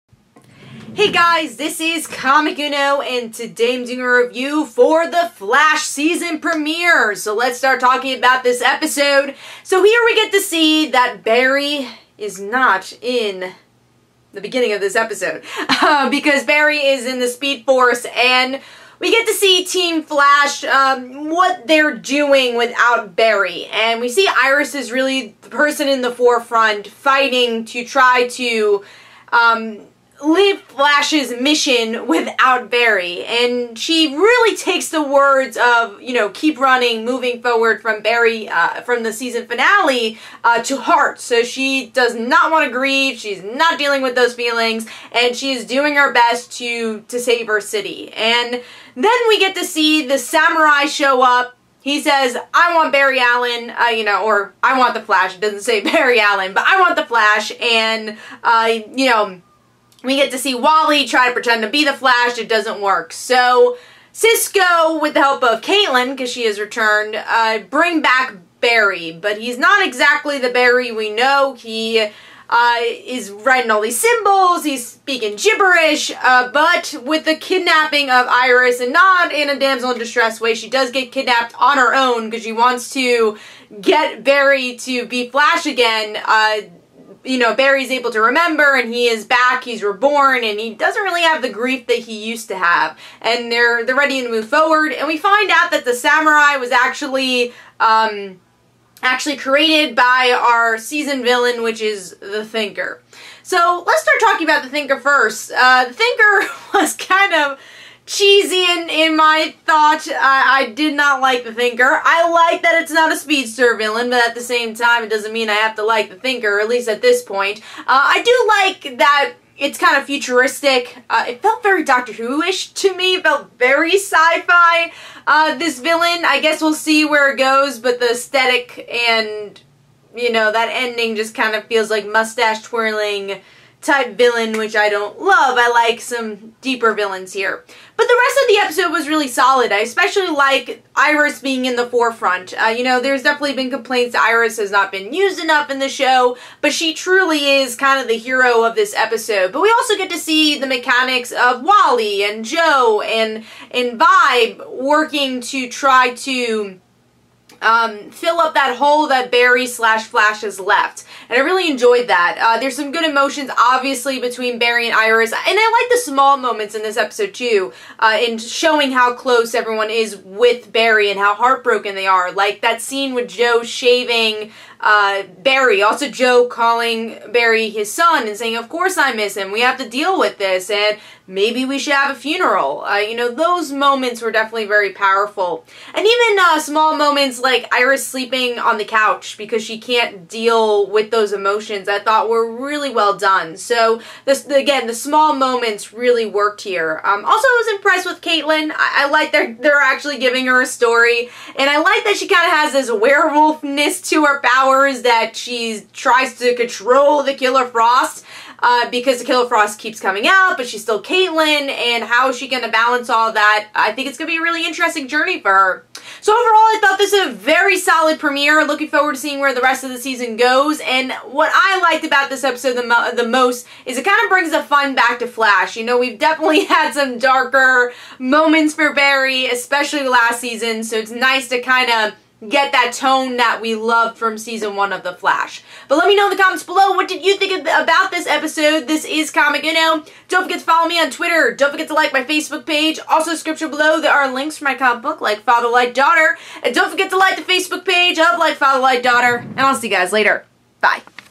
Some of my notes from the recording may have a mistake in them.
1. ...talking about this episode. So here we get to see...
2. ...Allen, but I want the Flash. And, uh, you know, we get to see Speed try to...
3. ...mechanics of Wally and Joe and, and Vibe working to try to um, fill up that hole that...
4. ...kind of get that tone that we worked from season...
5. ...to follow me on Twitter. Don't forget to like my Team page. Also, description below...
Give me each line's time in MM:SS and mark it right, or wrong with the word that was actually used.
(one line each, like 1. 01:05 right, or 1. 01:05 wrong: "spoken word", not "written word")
1. 00:07 right
2. 00:56 wrong: "Wally", not "Speed"
3. 02:30 right
4. 03:51 wrong: "loved", not "worked"
5. 04:00 wrong: "Facebook", not "Team".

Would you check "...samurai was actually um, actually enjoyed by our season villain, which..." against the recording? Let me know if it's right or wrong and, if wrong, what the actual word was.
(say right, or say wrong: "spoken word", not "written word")
wrong: "created", not "enjoyed".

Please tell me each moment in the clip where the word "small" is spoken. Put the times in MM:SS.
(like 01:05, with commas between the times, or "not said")
02:46, 03:06, 03:14.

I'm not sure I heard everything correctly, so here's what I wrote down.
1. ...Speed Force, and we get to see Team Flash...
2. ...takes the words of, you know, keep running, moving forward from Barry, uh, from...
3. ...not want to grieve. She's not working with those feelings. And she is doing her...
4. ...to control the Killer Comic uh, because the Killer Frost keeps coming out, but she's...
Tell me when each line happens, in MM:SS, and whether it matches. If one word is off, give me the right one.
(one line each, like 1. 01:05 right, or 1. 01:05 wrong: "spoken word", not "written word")
1. 00:17 right
2. 00:34 right
3. 00:42 wrong: "dealing", not "working"
4. 03:26 wrong: "Frost", not "Comic".